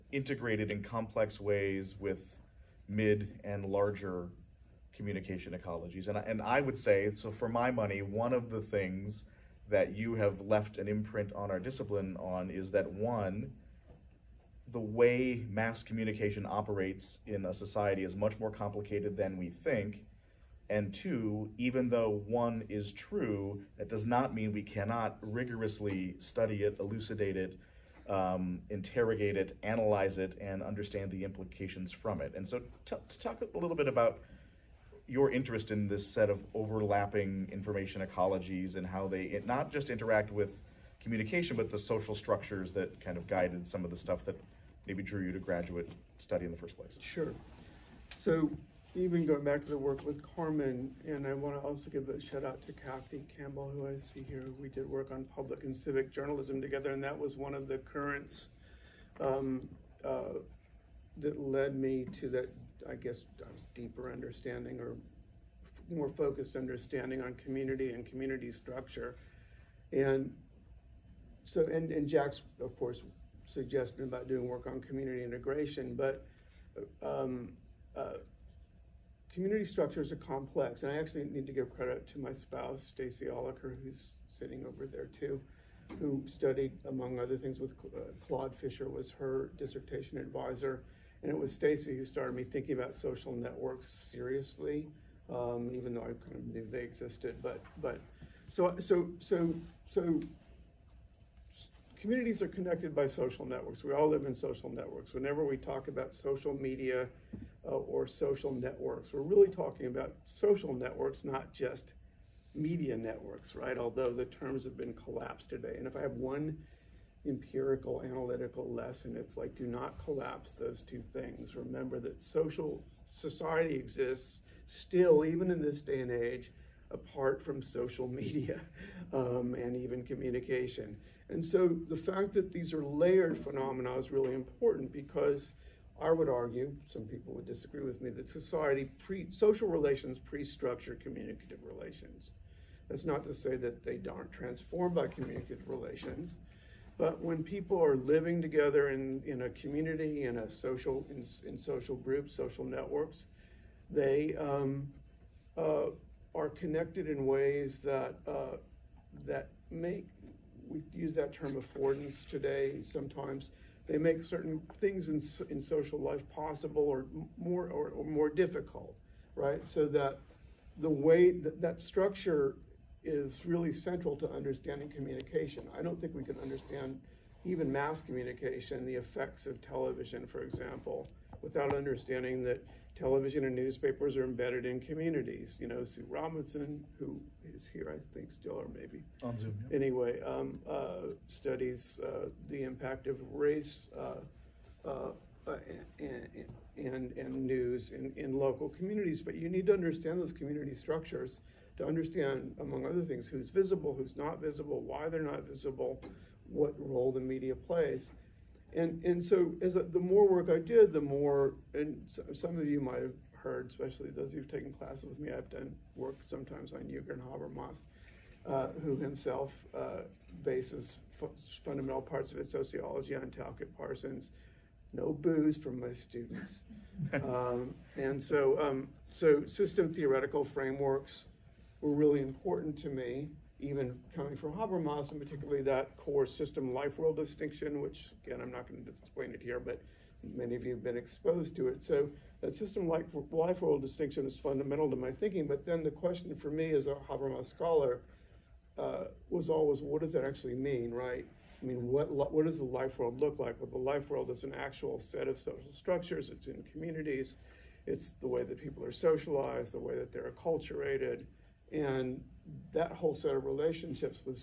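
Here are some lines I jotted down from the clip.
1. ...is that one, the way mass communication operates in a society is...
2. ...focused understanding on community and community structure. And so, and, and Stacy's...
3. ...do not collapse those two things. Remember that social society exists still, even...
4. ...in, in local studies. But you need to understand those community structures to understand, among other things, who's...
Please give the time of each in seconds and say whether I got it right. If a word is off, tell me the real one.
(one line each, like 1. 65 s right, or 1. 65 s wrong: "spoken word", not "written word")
1. 12 s right
2. 66 s wrong: "Jack", not "Stacy"
3. 119 s right
4. 197 s wrong: "communities", not "studies".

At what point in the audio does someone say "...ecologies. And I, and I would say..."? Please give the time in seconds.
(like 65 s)
5 s.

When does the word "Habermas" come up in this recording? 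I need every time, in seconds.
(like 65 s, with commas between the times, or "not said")
217 s, 234 s, 247 s.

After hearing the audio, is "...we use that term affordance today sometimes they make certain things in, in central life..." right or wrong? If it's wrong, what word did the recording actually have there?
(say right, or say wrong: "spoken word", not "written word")
wrong: "social", not "central".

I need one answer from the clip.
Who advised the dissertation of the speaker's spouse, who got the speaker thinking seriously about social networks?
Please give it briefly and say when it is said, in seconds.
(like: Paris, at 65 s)
Claude Fischer, at 88 s.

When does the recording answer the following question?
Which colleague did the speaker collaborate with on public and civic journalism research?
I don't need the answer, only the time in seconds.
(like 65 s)
52 s.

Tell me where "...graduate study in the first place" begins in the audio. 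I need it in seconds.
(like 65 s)
45 s.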